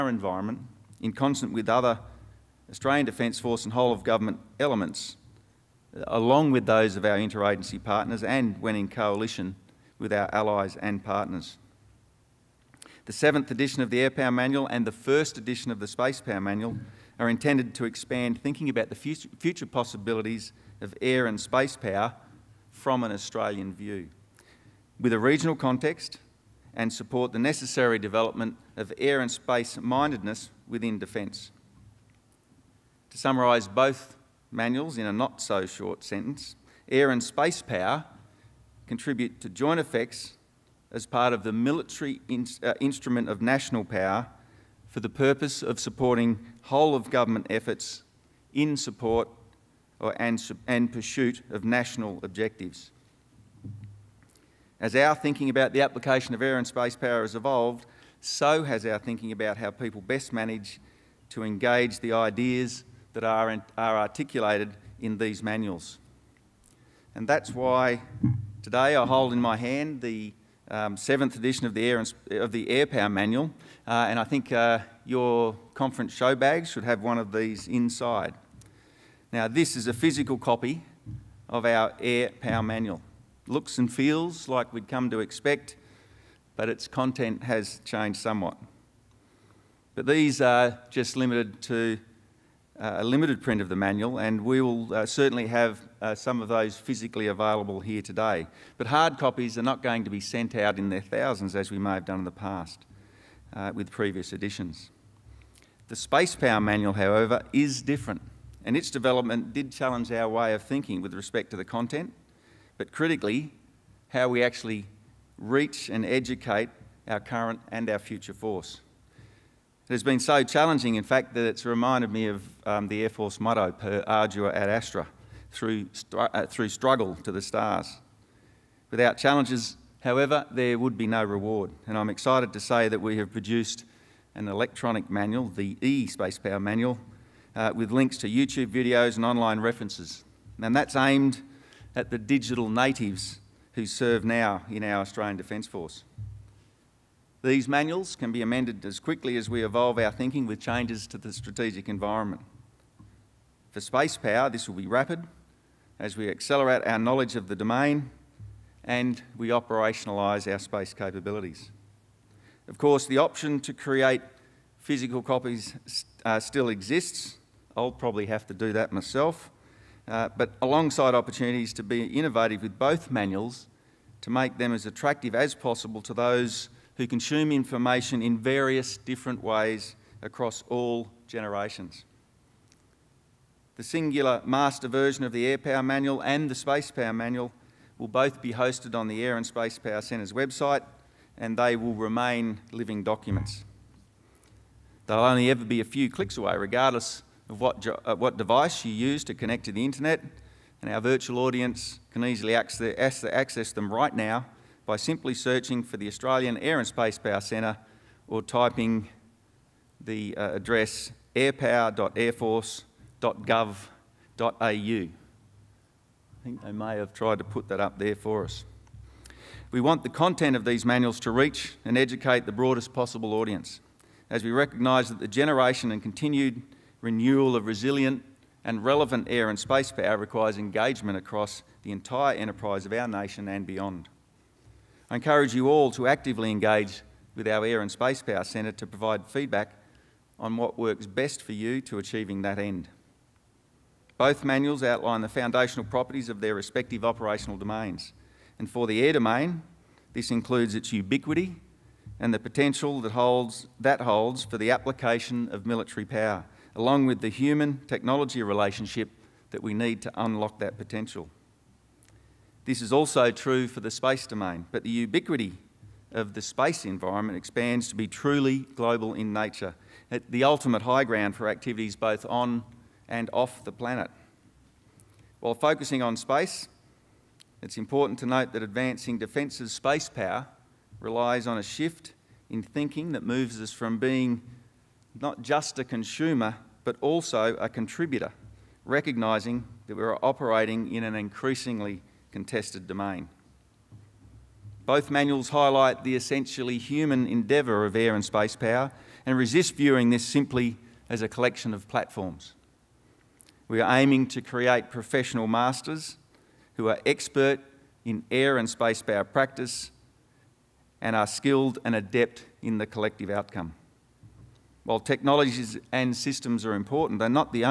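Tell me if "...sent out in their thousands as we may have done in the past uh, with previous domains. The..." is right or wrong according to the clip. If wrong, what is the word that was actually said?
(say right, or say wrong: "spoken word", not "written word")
wrong: "editions", not "domains".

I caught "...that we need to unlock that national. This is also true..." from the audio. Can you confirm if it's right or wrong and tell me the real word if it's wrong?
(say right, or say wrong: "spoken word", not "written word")
wrong: "potential", not "national".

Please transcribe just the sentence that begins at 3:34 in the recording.
I think they may have tried to put that up there for us.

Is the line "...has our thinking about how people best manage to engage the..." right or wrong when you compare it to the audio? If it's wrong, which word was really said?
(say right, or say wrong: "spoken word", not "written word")
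right.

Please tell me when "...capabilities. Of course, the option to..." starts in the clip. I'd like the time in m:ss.
2:40.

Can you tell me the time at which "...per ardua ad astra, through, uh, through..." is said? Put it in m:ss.
2:03.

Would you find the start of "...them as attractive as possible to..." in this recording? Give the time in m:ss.
2:54.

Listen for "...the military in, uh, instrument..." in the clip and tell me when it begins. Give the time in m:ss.
0:41.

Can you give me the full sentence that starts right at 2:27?
These manuals can be amended as quickly as we evolve our thinking with changes to the strategic environment.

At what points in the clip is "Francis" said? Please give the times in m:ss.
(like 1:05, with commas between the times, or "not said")
not said.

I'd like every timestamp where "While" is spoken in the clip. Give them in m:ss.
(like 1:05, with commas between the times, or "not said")
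4:35, 5:14.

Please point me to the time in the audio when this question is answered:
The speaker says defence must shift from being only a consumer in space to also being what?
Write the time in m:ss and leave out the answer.
4:47.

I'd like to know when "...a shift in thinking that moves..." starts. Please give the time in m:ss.
4:41.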